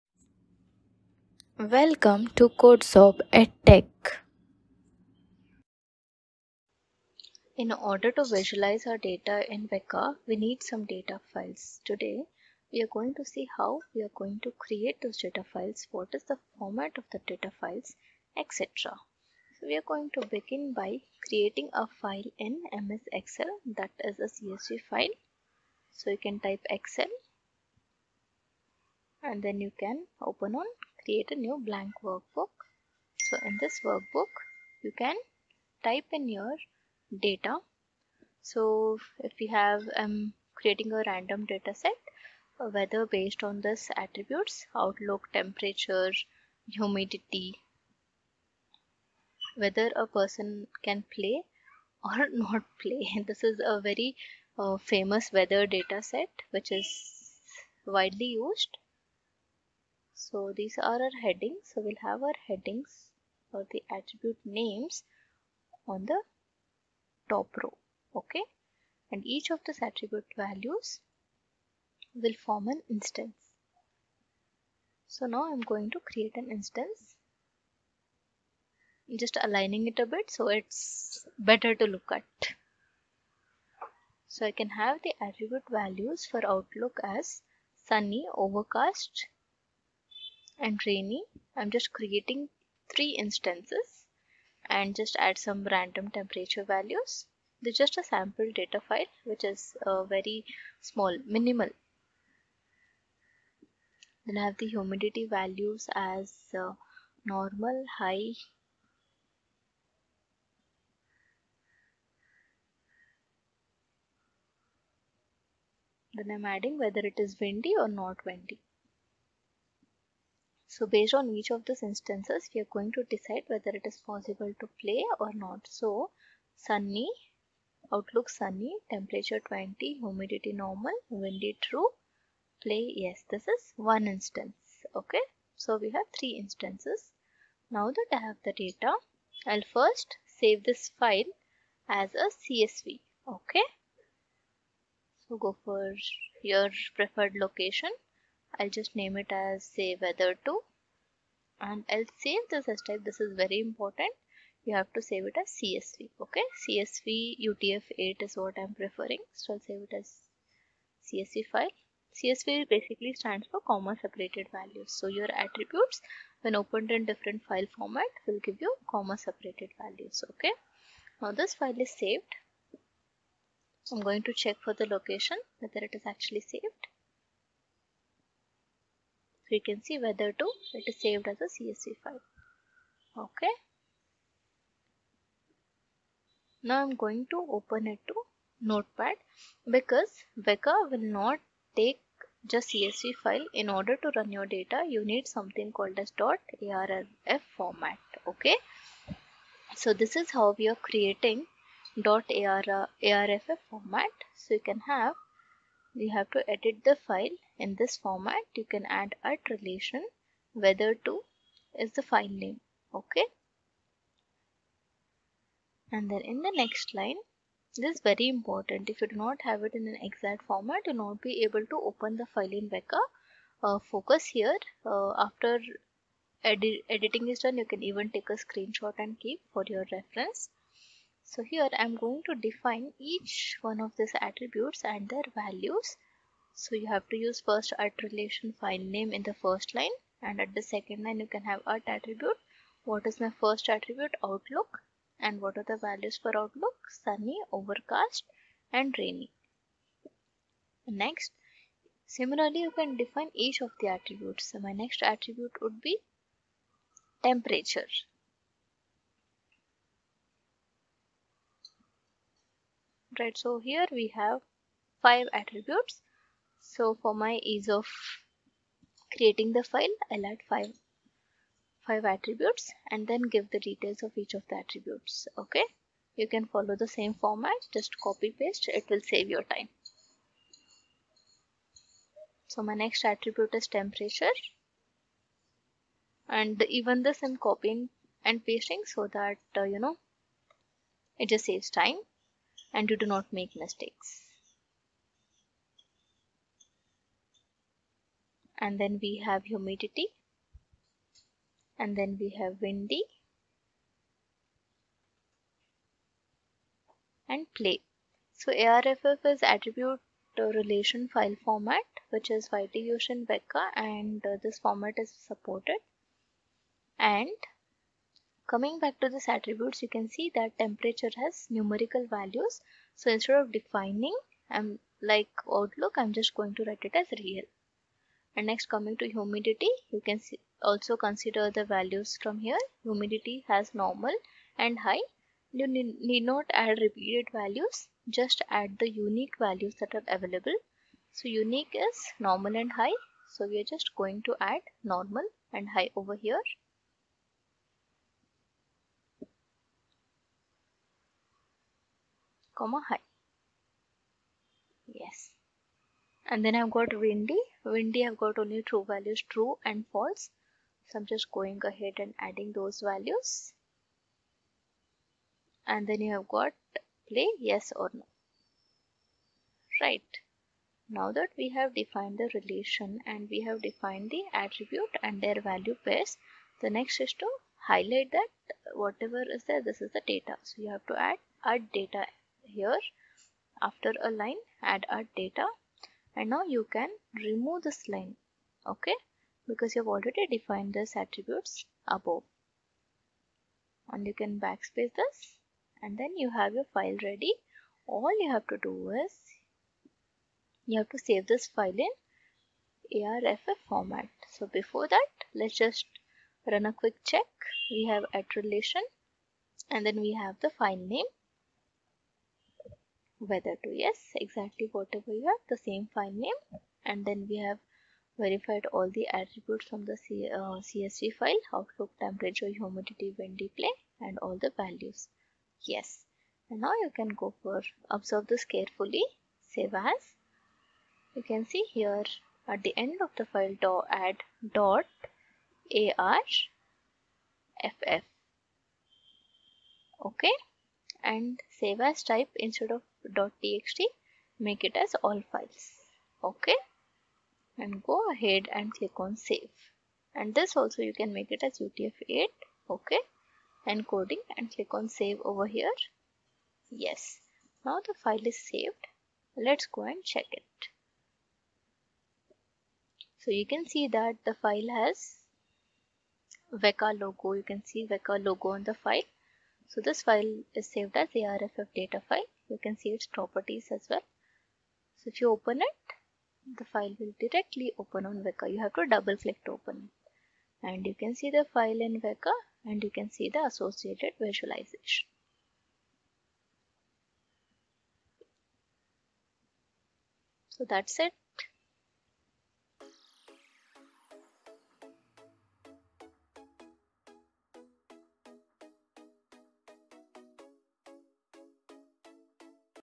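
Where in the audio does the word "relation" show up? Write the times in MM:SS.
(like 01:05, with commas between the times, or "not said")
03:29, 03:58, 05:10, 06:12, 06:48.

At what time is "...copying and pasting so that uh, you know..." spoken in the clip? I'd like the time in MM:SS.
04:47.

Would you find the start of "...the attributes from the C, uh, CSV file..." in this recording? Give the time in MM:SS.
06:58.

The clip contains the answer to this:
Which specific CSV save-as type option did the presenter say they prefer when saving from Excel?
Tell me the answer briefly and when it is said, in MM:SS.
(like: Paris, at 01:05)
CSV UTF-8, at 02:36.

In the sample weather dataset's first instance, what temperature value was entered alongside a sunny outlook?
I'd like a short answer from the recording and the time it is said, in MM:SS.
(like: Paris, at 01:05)
20, at 02:08.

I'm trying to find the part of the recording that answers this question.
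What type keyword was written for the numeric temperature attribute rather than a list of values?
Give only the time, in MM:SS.
05:27.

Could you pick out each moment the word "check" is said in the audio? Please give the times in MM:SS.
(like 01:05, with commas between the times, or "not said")
02:54, 06:47, 07:40.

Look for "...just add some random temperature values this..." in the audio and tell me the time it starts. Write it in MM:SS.
01:34.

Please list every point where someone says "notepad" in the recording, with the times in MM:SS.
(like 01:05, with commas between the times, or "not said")
03:08.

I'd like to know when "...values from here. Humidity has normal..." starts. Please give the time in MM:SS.
05:31.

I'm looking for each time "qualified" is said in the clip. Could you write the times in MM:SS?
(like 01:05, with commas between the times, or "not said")
not said.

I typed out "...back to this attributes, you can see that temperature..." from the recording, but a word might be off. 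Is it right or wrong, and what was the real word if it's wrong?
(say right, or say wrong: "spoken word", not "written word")
right.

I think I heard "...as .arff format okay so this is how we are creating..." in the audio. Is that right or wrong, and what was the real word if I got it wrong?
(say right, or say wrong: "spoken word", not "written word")
right.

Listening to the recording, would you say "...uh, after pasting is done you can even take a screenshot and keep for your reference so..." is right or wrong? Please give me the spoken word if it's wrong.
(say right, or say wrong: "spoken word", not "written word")
wrong: "editing", not "pasting".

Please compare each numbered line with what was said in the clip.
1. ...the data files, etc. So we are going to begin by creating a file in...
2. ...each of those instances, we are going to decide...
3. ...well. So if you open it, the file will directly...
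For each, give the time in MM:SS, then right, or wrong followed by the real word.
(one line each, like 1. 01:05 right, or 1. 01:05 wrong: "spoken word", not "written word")
1. 00:17 right
2. 02:01 right
3. 07:53 right.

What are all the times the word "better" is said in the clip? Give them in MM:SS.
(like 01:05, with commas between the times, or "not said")
01:21.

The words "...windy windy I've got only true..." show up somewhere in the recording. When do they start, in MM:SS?
05:57.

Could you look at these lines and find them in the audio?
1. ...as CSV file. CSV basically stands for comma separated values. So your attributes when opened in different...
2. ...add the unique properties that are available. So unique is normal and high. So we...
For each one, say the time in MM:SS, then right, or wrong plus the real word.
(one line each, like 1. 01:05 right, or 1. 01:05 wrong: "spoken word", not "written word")
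1. 02:39 right
2. 05:38 wrong: "values", not "properties".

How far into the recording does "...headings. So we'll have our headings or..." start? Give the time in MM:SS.
01:01.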